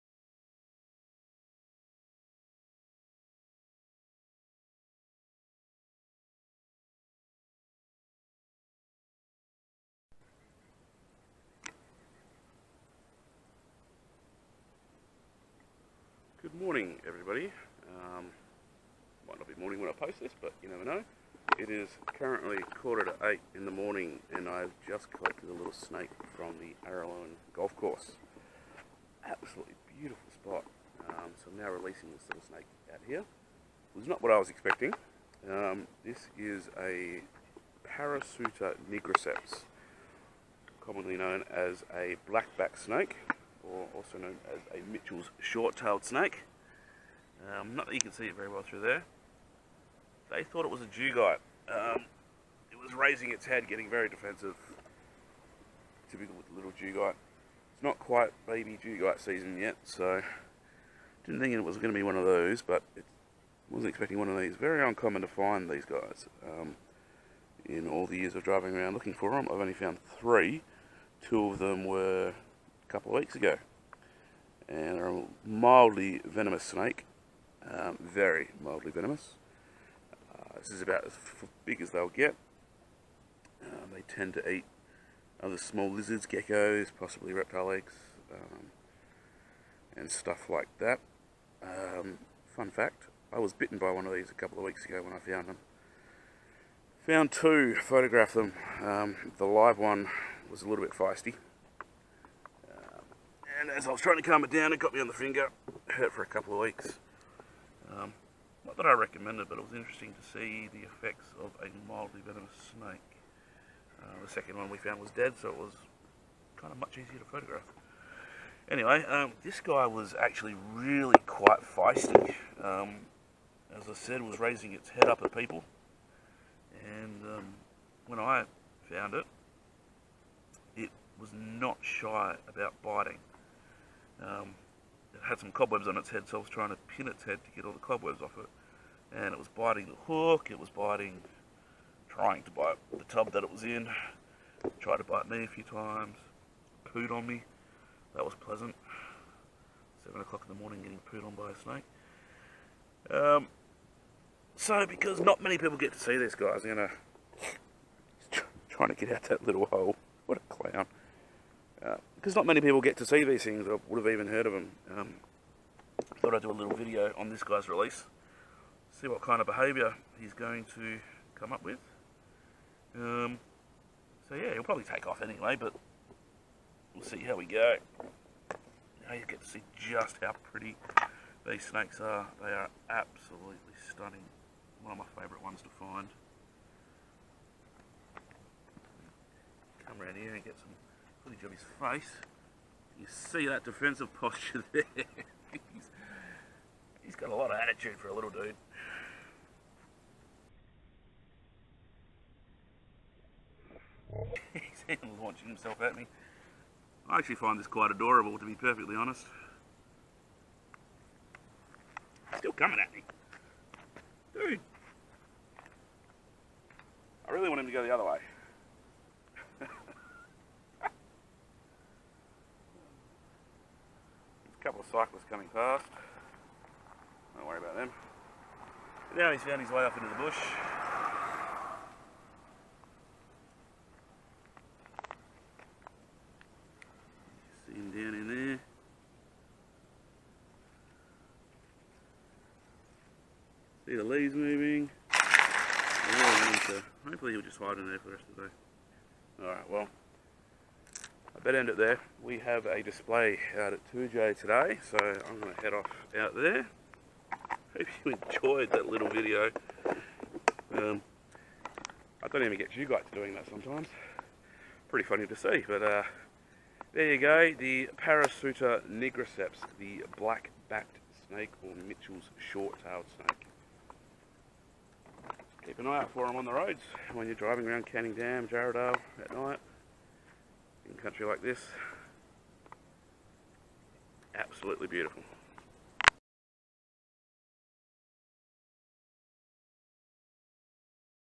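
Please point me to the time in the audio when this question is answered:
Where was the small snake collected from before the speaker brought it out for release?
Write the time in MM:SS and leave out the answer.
00:26.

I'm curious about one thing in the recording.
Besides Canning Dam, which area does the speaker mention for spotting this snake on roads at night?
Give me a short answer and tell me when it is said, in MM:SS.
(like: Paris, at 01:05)
Jarradale, at 04:38.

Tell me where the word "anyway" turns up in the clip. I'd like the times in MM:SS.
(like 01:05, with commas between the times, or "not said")
01:58, 02:55.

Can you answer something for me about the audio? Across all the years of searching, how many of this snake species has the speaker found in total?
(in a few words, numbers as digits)
3.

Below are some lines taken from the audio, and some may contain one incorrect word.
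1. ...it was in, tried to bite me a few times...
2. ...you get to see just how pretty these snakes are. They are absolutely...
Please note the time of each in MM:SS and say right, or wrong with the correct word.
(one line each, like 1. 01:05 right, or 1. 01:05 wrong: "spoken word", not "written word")
1. 02:23 right
2. 02:59 right.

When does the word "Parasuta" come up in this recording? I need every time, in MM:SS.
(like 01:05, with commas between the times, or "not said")
00:37, 04:27.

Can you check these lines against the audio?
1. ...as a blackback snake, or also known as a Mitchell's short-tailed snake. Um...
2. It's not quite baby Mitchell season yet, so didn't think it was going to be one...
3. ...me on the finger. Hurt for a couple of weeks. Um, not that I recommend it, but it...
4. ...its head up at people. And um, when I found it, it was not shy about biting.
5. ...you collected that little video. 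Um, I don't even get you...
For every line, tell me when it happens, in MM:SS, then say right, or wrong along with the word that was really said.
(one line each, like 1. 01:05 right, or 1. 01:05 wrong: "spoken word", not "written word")
1. 00:41 right
2. 00:57 wrong: "Dugite", not "Mitchell"
3. 01:44 right
4. 02:04 right
5. 04:18 wrong: "enjoyed", not "collected".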